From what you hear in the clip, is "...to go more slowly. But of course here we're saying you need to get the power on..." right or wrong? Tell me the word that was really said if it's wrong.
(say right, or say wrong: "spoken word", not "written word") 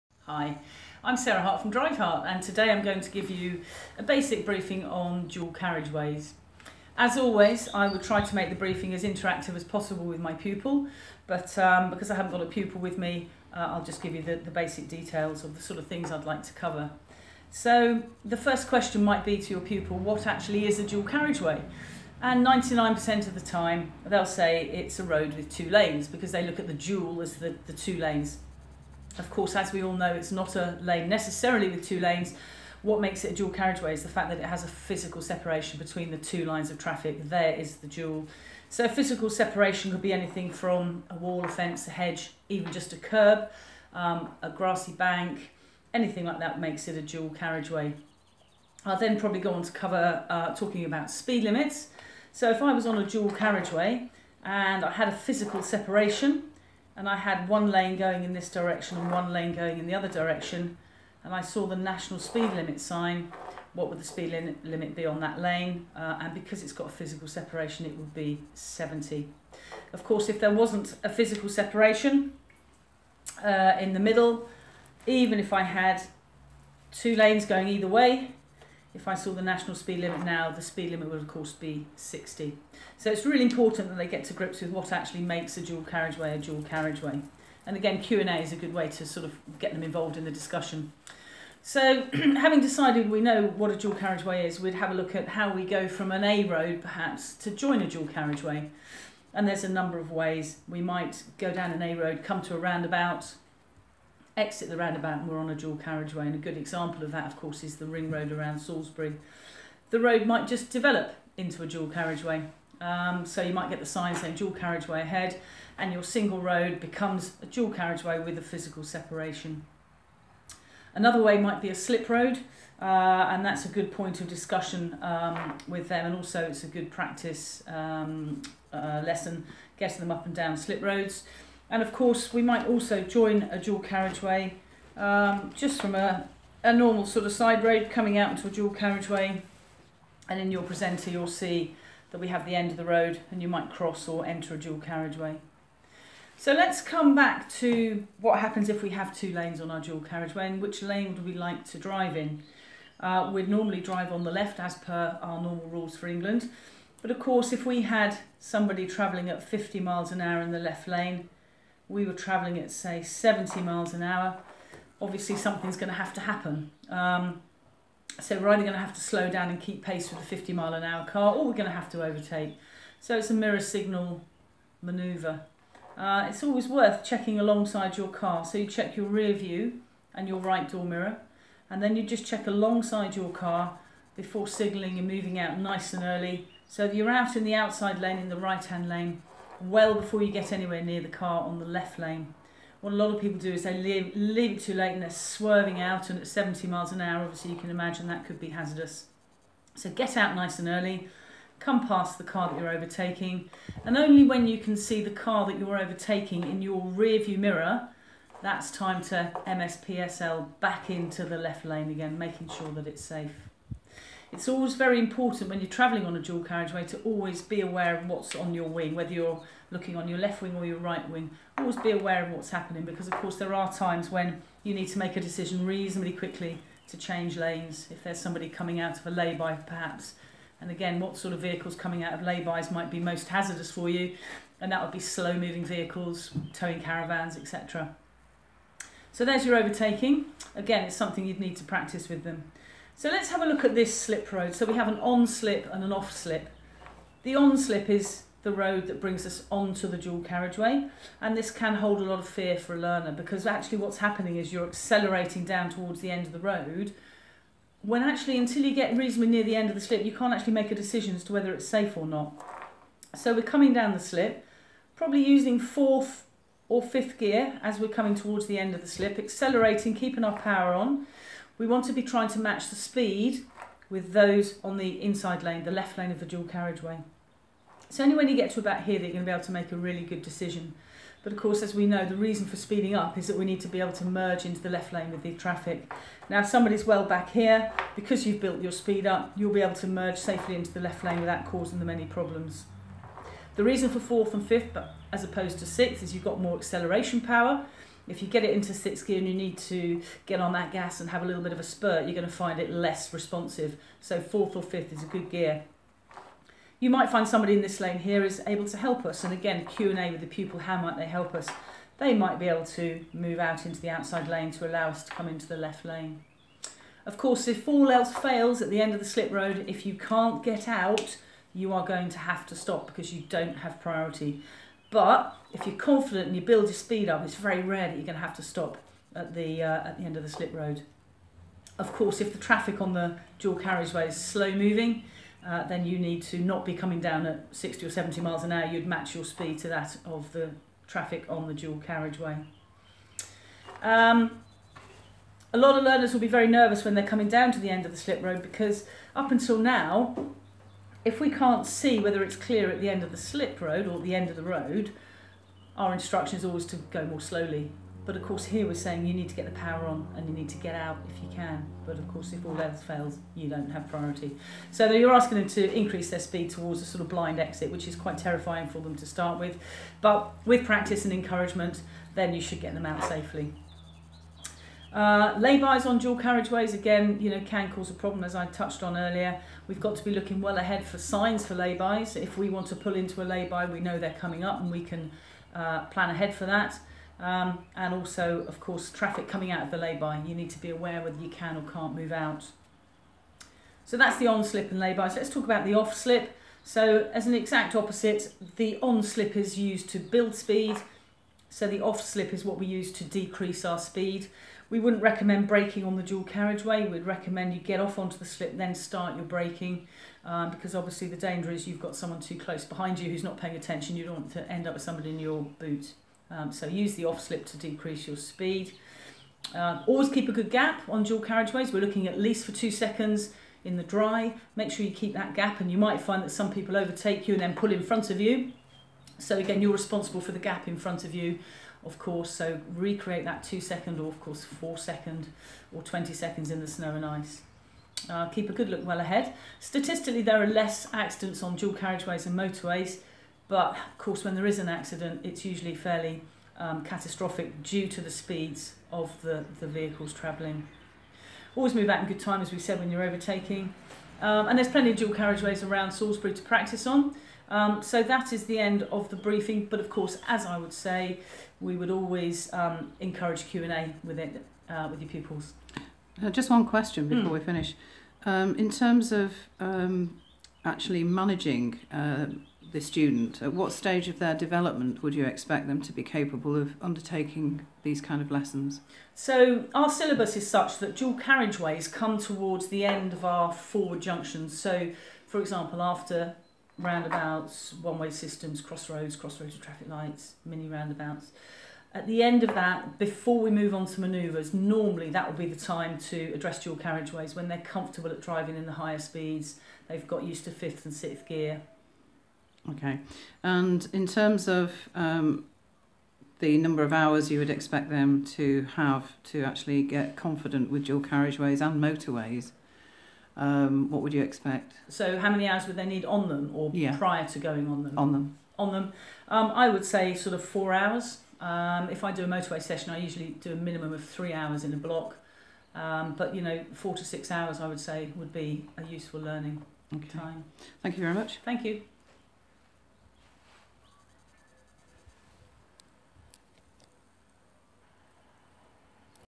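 right.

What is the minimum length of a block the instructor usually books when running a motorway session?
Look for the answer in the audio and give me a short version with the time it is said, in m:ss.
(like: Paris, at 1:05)
3 hours, at 8:44.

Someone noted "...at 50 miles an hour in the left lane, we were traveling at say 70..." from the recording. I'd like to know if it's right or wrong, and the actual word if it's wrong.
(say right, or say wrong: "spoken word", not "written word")
right.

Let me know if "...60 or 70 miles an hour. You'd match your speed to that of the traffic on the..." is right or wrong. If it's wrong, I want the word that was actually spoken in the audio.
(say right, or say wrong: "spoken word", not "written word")
right.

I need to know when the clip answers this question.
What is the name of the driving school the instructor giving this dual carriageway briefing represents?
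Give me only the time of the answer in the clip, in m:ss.
0:01.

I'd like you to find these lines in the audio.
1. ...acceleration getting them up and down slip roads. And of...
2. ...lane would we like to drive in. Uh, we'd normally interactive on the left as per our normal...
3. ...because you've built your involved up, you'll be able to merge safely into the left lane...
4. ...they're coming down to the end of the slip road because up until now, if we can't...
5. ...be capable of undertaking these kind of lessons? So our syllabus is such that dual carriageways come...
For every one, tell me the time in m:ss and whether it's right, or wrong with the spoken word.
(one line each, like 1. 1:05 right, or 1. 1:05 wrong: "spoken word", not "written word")
1. 2:09 wrong: "lesson", not "acceleration"
2. 2:30 wrong: "drive", not "interactive"
3. 4:47 wrong: "speed", not "involved"
4. 5:46 right
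5. 7:55 right.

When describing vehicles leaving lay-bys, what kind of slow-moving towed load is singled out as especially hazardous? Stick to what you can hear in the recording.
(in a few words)
Caravans.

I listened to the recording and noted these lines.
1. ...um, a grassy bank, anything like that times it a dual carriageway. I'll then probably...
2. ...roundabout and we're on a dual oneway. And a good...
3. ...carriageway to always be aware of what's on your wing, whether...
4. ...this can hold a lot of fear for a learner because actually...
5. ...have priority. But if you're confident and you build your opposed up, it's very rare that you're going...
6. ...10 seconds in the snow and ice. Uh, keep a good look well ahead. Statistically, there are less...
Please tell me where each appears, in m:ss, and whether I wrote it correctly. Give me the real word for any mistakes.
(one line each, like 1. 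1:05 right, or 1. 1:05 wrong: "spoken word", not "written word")
1. 0:43 wrong: "makes", not "times"
2. 1:44 wrong: "carriageway", not "oneway"
3. 3:36 right
4. 4:11 right
5. 5:23 wrong: "speed", not "opposed"
6. 7:15 wrong: "20", not "10".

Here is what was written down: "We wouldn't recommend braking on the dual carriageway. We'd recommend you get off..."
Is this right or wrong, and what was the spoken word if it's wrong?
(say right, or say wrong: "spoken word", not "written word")
right.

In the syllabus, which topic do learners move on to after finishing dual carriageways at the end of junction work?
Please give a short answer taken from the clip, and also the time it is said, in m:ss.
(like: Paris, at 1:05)
Manoeuvres, at 8:14.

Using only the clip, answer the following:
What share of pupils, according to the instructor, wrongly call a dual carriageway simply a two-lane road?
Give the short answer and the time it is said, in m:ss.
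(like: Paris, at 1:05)
99%, at 0:22.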